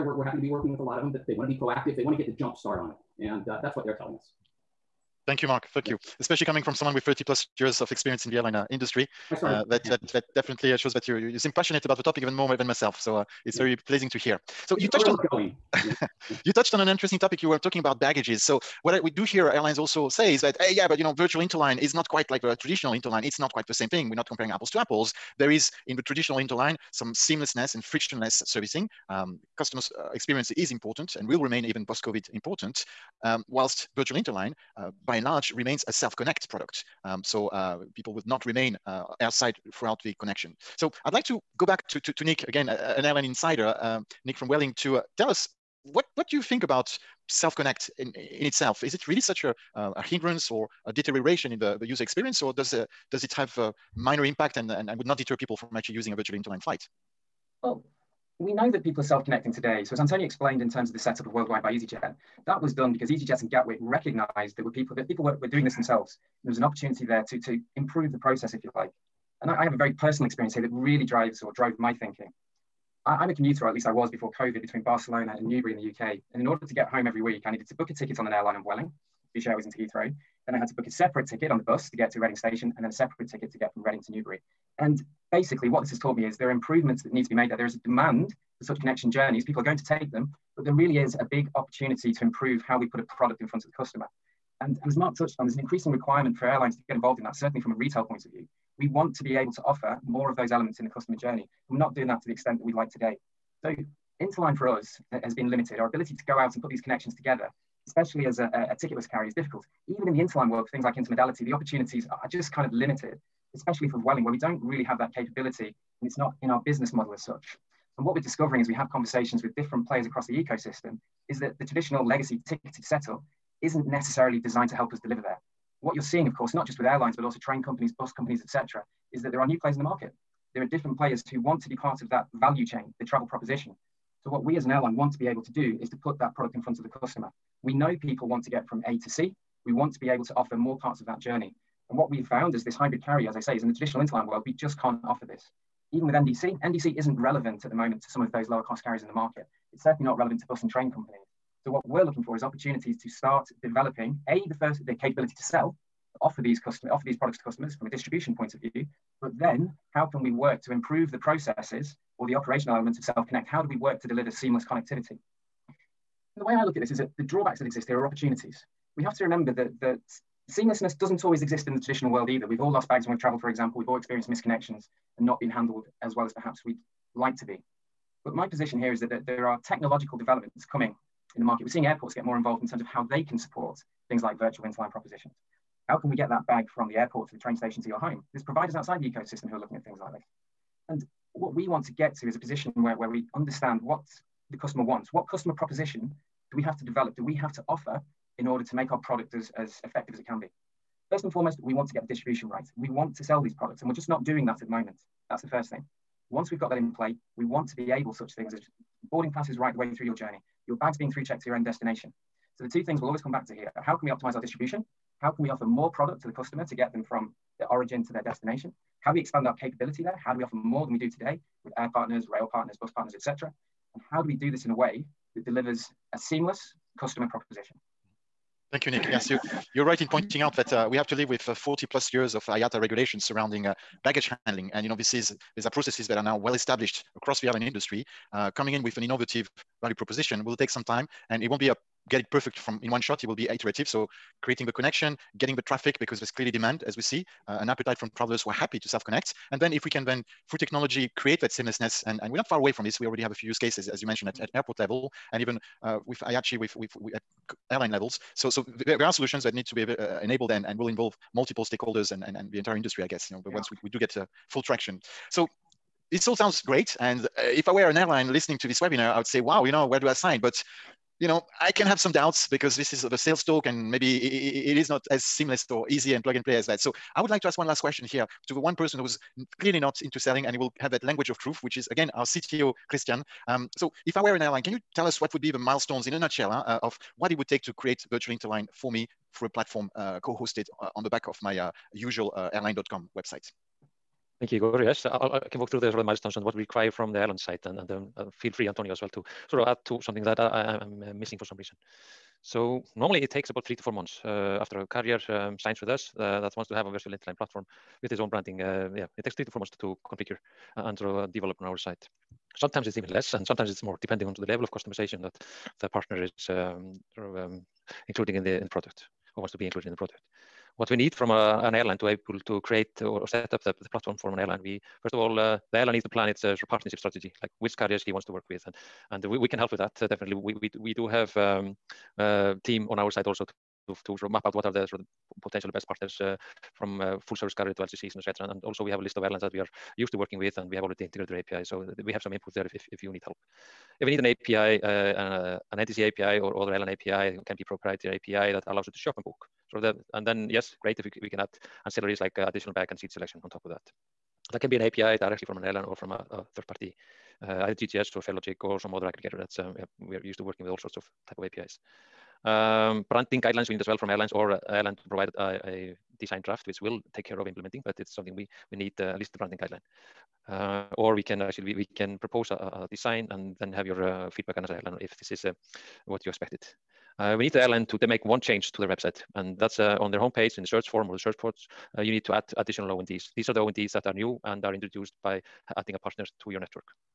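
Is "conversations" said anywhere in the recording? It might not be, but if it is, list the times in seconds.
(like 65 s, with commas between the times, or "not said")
118 s.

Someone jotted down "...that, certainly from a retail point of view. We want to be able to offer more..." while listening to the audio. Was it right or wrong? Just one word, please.
right.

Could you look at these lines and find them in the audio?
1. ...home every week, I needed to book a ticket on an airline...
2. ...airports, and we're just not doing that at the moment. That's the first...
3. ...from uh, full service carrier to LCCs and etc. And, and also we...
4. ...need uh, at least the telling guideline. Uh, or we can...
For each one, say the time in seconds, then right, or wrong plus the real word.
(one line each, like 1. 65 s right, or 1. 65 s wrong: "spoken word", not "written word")
1. 76 s right
2. 203 s wrong: "products", not "airports"
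3. 336 s right
4. 368 s wrong: "branding", not "telling".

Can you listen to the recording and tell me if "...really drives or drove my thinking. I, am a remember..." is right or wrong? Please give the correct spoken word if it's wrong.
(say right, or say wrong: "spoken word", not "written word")
wrong: "commuter", not "remember".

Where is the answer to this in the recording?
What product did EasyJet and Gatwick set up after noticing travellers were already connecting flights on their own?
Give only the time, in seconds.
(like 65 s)
61 s.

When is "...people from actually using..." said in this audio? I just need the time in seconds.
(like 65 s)
55 s.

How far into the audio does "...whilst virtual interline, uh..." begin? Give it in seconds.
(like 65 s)
33 s.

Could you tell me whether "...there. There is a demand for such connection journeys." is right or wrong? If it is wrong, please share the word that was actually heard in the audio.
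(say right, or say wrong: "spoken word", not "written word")
right.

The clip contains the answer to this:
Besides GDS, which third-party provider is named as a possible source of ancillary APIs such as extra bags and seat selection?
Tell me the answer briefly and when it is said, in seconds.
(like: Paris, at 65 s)
Farelogix, at 358 s.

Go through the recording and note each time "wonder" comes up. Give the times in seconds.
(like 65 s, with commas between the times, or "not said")
not said.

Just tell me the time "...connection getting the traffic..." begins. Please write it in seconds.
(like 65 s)
244 s.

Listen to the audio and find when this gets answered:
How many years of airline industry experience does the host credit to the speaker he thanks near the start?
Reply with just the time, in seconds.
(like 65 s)
7 s.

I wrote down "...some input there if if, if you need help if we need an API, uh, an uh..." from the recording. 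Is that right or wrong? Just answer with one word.
right.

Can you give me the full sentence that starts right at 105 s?
Our ability to go out and put these connections together, especially as a, a, a ticketless carrier, is difficult.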